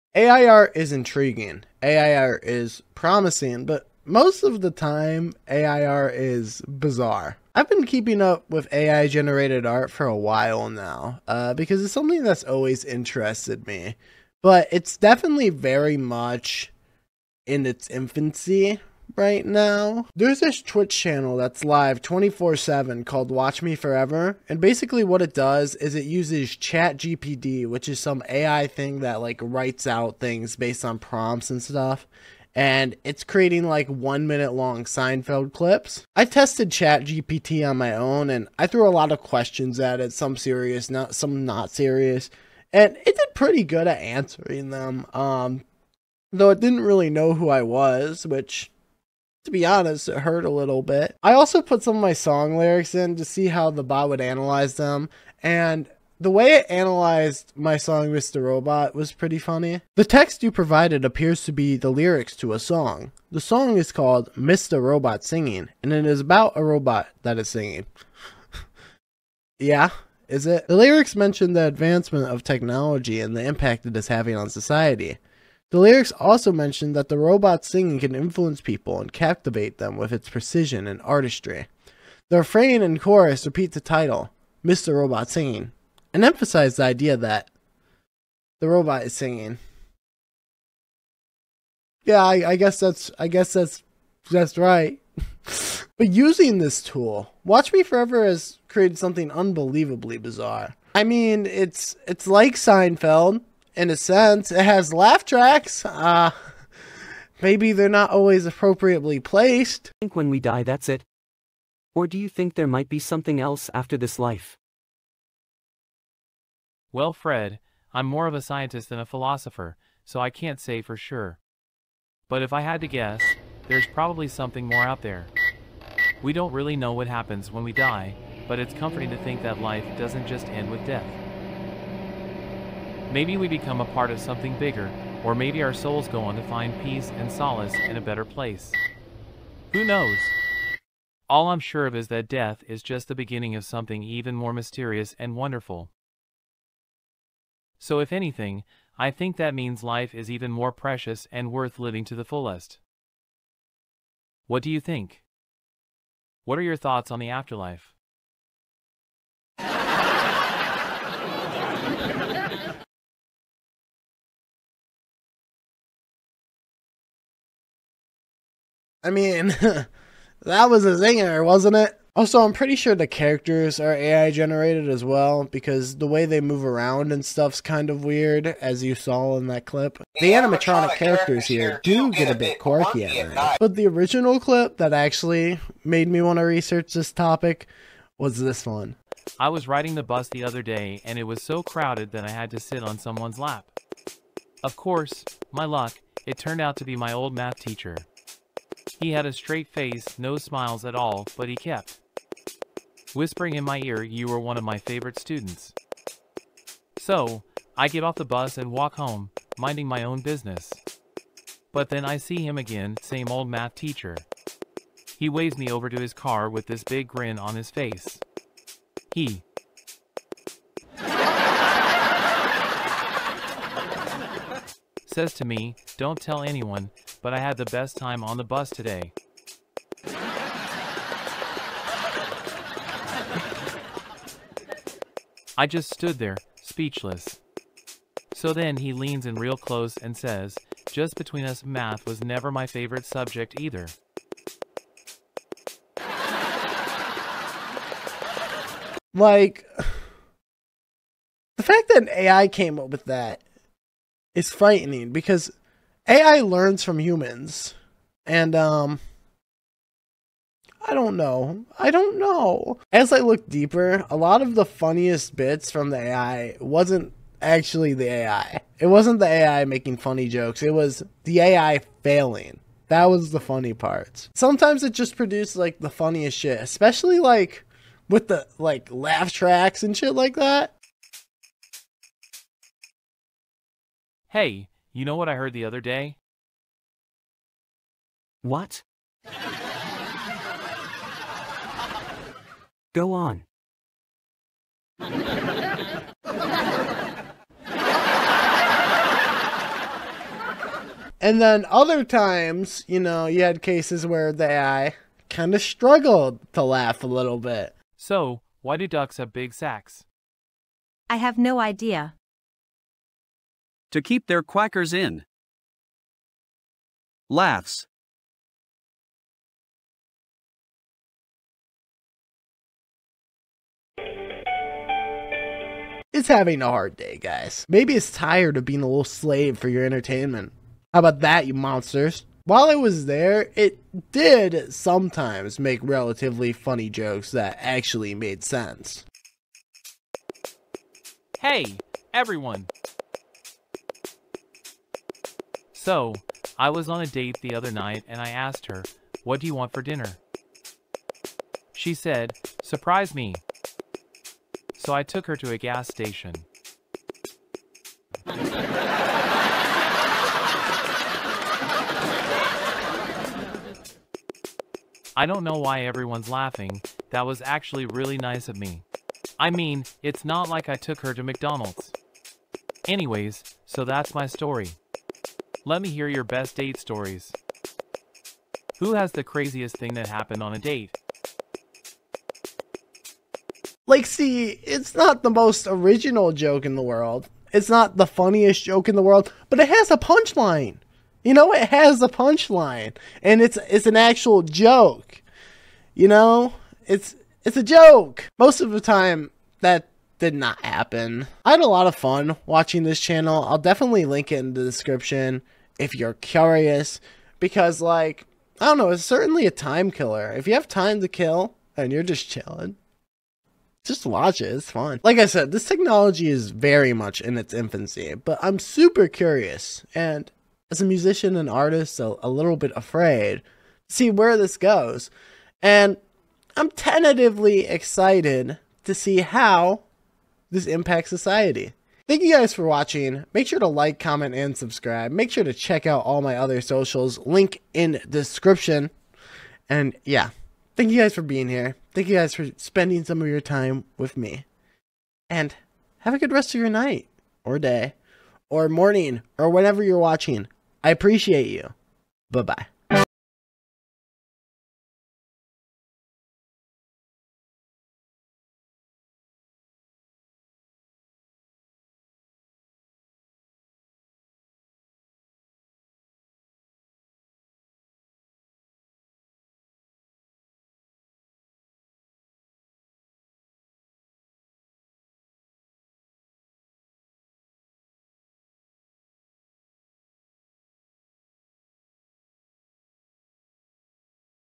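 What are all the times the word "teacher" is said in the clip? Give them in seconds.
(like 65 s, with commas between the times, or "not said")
197 s, 213 s.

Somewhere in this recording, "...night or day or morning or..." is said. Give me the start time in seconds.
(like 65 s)
446 s.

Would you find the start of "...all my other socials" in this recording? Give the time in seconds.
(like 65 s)
436 s.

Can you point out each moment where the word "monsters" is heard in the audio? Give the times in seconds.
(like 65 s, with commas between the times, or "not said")
331 s.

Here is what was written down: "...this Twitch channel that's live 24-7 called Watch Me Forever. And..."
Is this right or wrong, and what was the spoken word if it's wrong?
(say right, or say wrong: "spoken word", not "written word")
right.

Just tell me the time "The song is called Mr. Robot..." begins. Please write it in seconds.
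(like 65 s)
63 s.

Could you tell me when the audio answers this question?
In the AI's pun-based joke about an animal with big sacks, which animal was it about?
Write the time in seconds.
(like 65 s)
308 s.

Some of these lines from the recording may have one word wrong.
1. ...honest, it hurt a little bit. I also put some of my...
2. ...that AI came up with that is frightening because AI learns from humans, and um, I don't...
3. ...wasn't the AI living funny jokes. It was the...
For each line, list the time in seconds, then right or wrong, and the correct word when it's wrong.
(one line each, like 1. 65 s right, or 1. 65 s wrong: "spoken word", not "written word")
1. 49 s right
2. 251 s right
3. 268 s wrong: "making", not "living".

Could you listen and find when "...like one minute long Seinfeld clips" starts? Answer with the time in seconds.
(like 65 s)
33 s.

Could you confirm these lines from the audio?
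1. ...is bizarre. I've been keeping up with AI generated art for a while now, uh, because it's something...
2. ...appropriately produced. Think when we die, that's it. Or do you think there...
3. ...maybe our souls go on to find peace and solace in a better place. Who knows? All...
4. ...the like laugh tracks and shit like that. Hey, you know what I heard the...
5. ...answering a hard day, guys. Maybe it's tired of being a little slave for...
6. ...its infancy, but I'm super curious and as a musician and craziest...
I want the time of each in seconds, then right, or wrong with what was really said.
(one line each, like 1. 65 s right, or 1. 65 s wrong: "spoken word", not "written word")
1. 6 s right
2. 108 s wrong: "placed", not "produced"
3. 135 s right
4. 278 s right
5. 326 s wrong: "having", not "answering"
6. 417 s wrong: "artist", not "craziest".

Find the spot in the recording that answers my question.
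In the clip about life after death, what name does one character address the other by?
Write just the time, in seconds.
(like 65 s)
117 s.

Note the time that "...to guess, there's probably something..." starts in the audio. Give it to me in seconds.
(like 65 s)
122 s.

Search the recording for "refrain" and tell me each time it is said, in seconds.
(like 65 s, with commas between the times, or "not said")
82 s.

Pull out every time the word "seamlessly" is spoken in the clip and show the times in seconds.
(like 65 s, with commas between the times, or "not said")
not said.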